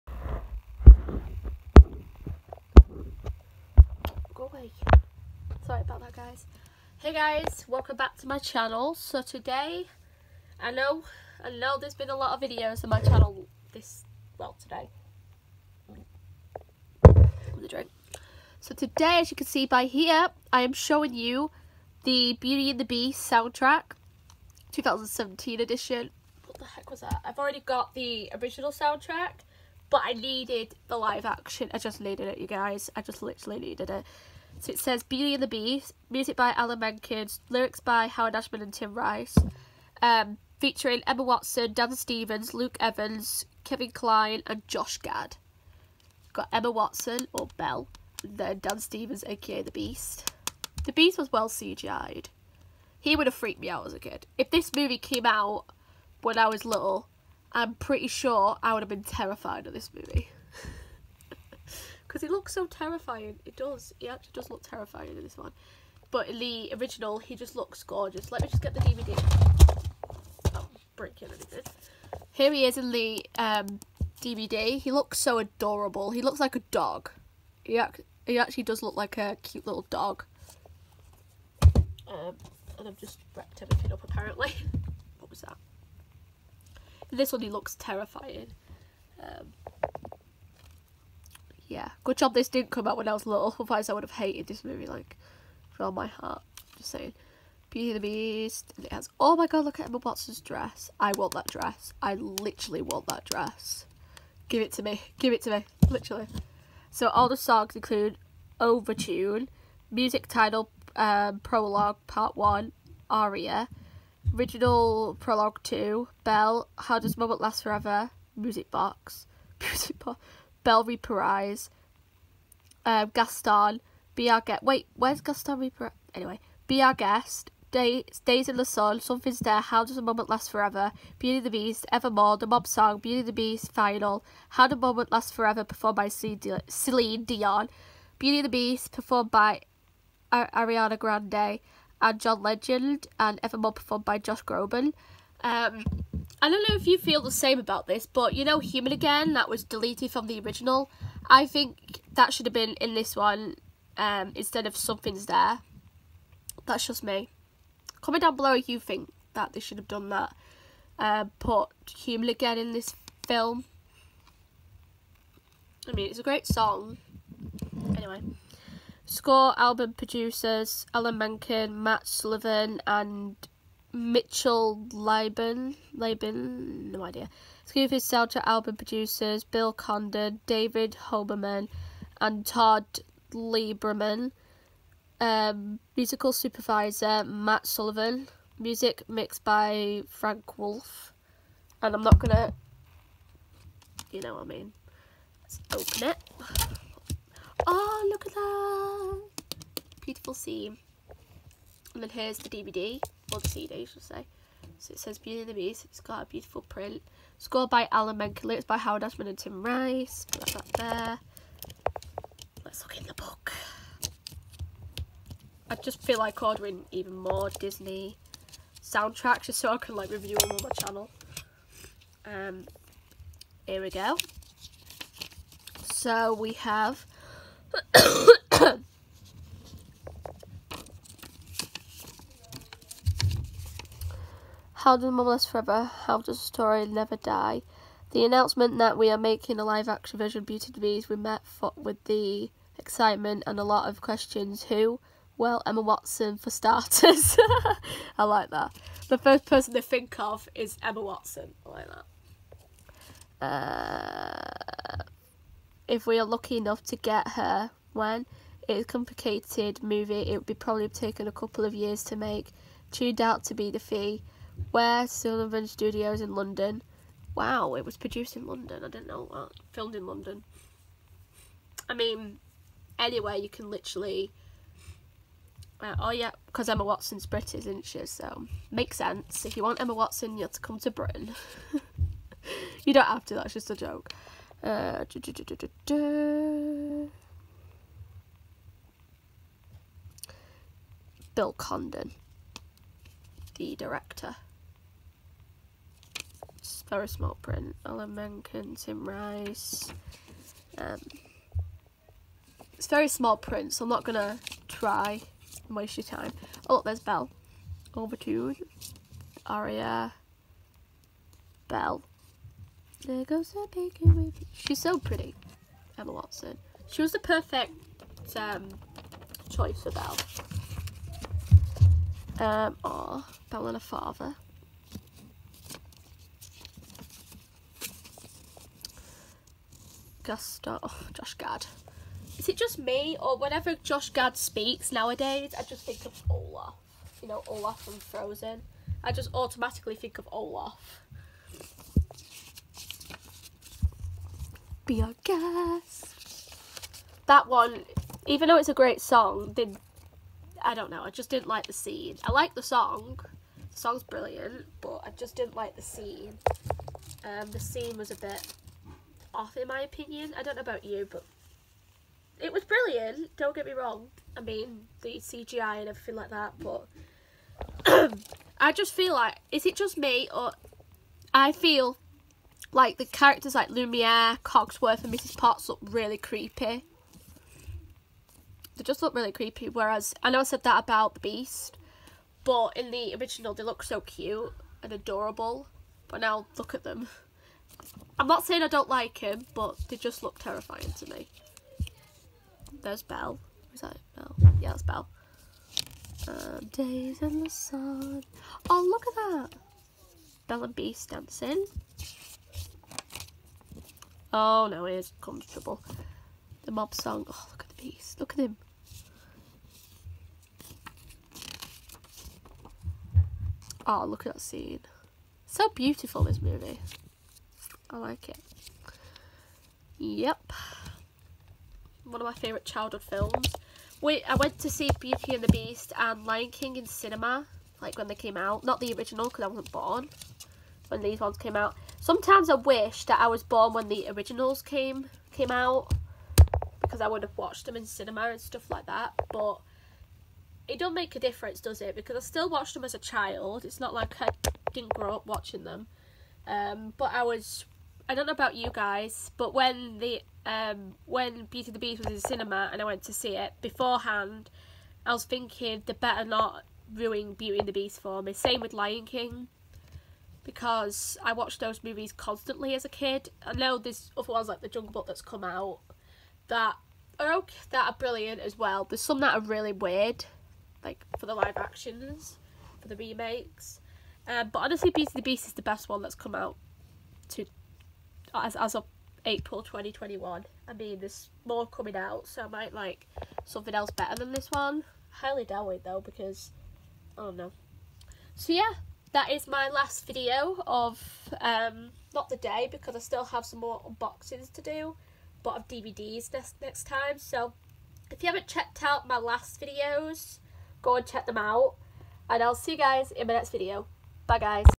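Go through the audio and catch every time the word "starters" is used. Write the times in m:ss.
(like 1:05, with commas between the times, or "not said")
4:06.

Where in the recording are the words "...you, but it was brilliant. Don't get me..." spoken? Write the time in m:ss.
6:00.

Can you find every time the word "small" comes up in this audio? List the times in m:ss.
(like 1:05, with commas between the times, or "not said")
4:57, 5:03.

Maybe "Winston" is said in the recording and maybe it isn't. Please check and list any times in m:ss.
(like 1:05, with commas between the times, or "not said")
not said.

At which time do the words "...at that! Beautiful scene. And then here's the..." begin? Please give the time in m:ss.
3:18.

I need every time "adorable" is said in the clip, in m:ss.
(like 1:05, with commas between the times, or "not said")
1:15, 6:24.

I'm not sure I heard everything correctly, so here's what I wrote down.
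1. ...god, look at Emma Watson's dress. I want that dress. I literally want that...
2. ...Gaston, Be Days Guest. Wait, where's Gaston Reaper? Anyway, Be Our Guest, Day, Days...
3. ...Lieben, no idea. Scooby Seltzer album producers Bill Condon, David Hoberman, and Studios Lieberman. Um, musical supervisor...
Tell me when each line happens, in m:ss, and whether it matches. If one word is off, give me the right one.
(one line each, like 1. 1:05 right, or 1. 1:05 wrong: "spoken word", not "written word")
1. 1:39 right
2. 2:03 wrong: "Our", not "Days"
3. 2:55 wrong: "Todd", not "Studios".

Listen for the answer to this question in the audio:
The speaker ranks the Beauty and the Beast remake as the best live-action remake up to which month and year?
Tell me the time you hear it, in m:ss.
7:59.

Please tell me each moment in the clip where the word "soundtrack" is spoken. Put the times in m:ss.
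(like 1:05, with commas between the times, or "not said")
0:23, 0:28, 3:38.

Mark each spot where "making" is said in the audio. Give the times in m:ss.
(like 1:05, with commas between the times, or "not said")
3:59.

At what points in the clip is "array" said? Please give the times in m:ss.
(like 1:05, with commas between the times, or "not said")
not said.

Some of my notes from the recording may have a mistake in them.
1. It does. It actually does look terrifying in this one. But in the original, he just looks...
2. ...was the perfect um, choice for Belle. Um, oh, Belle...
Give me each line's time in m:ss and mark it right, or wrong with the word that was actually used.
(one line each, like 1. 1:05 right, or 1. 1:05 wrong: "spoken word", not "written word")
1. 1:03 right
2. 5:17 right.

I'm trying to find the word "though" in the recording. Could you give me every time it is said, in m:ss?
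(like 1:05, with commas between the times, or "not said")
5:48, 8:05.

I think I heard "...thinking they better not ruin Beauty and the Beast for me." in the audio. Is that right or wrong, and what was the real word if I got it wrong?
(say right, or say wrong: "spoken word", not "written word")
right.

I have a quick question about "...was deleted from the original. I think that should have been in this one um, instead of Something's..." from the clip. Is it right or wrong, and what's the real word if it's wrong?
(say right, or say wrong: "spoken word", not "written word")
right.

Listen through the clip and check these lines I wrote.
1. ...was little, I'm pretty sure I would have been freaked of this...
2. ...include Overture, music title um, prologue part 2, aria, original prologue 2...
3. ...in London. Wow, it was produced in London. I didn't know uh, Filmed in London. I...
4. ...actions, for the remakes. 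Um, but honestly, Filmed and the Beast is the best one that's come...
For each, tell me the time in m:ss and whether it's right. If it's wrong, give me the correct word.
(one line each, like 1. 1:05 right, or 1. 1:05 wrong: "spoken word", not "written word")
1. 0:56 wrong: "terrified", not "freaked"
2. 1:47 wrong: "1", not "2"
3. 4:26 right
4. 7:51 wrong: "Beauty", not "Filmed".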